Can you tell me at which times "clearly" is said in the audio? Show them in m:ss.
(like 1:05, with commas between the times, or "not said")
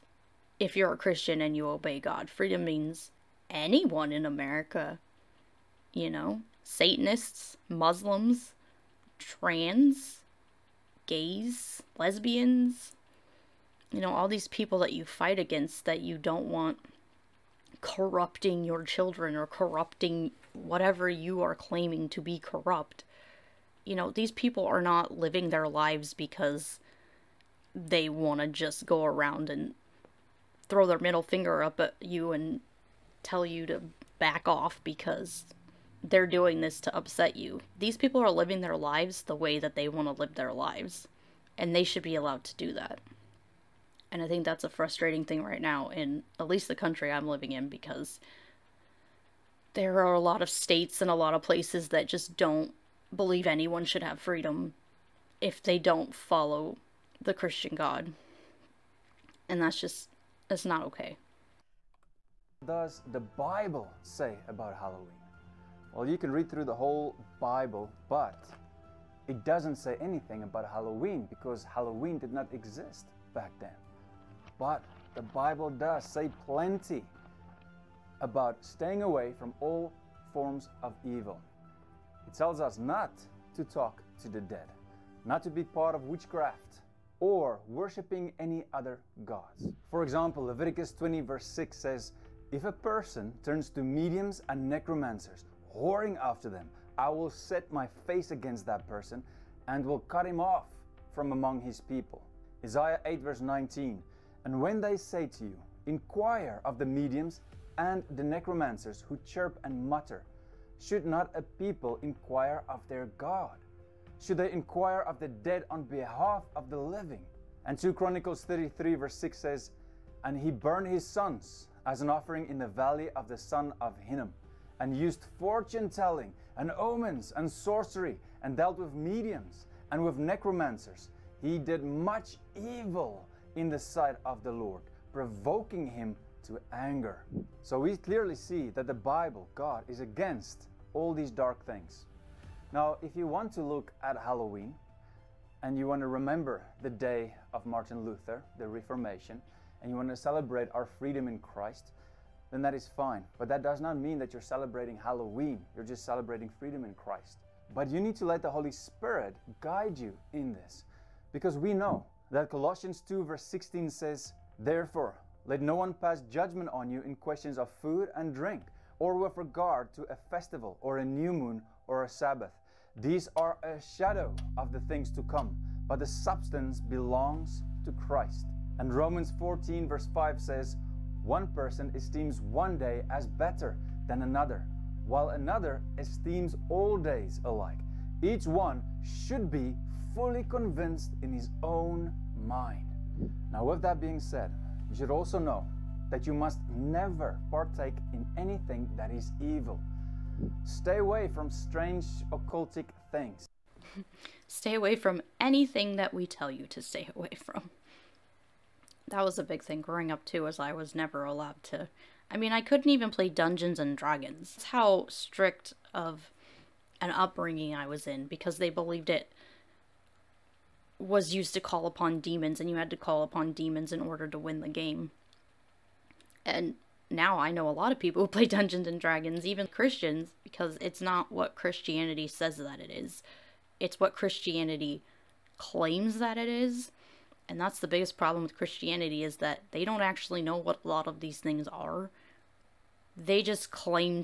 2:17.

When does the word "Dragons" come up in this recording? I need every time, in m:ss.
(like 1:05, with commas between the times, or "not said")
3:33, 3:48.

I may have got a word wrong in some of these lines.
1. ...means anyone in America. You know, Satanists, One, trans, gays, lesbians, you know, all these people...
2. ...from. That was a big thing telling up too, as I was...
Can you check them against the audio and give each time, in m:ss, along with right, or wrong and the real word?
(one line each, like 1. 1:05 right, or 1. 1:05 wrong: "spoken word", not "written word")
1. 0:02 wrong: "Muslims", not "One"
2. 3:27 wrong: "growing", not "telling".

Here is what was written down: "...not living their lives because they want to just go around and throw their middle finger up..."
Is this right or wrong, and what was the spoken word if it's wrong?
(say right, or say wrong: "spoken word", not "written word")
right.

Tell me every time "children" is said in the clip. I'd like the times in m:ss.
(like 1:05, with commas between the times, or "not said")
0:18.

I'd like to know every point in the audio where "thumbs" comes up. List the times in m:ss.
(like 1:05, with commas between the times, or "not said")
not said.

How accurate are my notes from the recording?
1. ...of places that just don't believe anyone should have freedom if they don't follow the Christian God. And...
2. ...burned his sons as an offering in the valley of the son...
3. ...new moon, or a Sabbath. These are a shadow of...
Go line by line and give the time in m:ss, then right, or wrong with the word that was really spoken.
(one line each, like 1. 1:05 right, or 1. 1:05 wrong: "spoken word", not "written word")
1. 0:51 right
2. 2:00 right
3. 2:51 right.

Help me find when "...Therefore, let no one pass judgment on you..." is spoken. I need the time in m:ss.
2:44.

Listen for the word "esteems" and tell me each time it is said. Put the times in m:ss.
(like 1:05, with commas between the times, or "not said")
3:01, 3:05.